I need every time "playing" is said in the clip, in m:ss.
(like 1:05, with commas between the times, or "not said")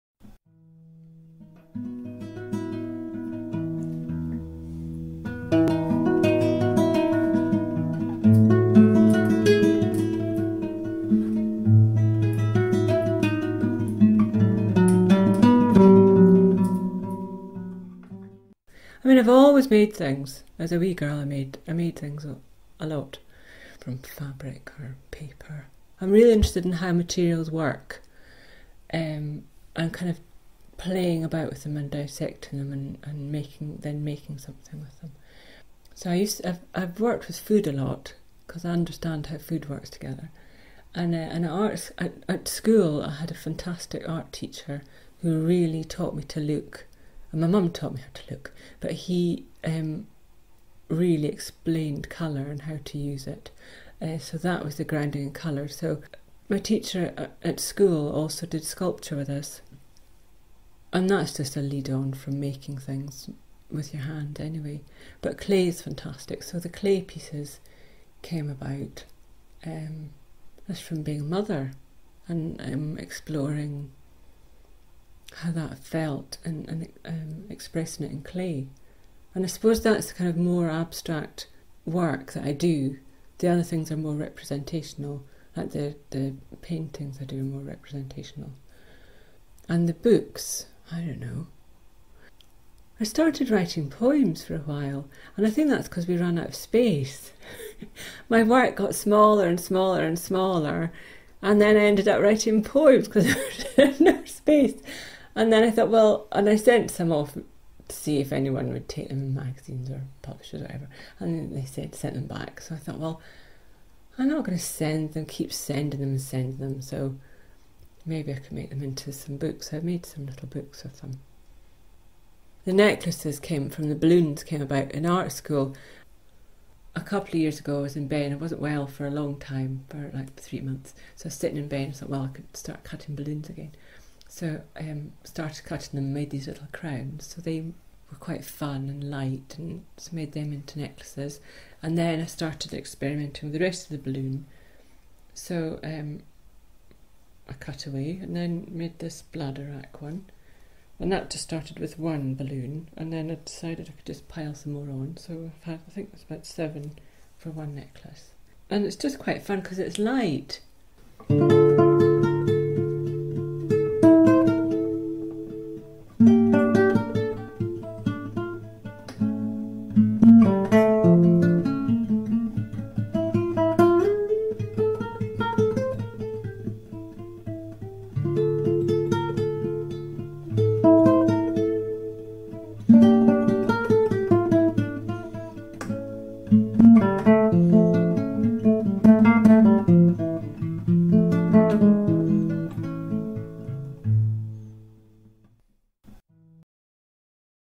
0:30.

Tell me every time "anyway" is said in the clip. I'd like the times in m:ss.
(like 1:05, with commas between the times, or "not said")
1:04.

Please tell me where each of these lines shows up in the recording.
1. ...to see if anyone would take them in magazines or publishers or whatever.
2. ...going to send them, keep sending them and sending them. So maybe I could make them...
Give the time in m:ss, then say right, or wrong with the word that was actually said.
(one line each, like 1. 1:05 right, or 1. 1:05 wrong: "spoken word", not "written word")
1. 1:47 right
2. 1:54 right.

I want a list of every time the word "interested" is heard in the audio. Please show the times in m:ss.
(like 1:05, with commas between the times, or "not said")
0:26.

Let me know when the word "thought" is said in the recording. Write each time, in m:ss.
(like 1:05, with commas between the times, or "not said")
1:45, 1:52, 2:11.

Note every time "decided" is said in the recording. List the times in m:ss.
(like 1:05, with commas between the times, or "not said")
2:33.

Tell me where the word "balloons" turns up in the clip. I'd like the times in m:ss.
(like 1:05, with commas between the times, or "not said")
2:03, 2:13, 2:24, 2:32.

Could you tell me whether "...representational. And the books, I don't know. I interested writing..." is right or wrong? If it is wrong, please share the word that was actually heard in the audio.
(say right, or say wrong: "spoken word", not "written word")
wrong: "started", not "interested".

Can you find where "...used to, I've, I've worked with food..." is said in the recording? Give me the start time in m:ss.
0:36.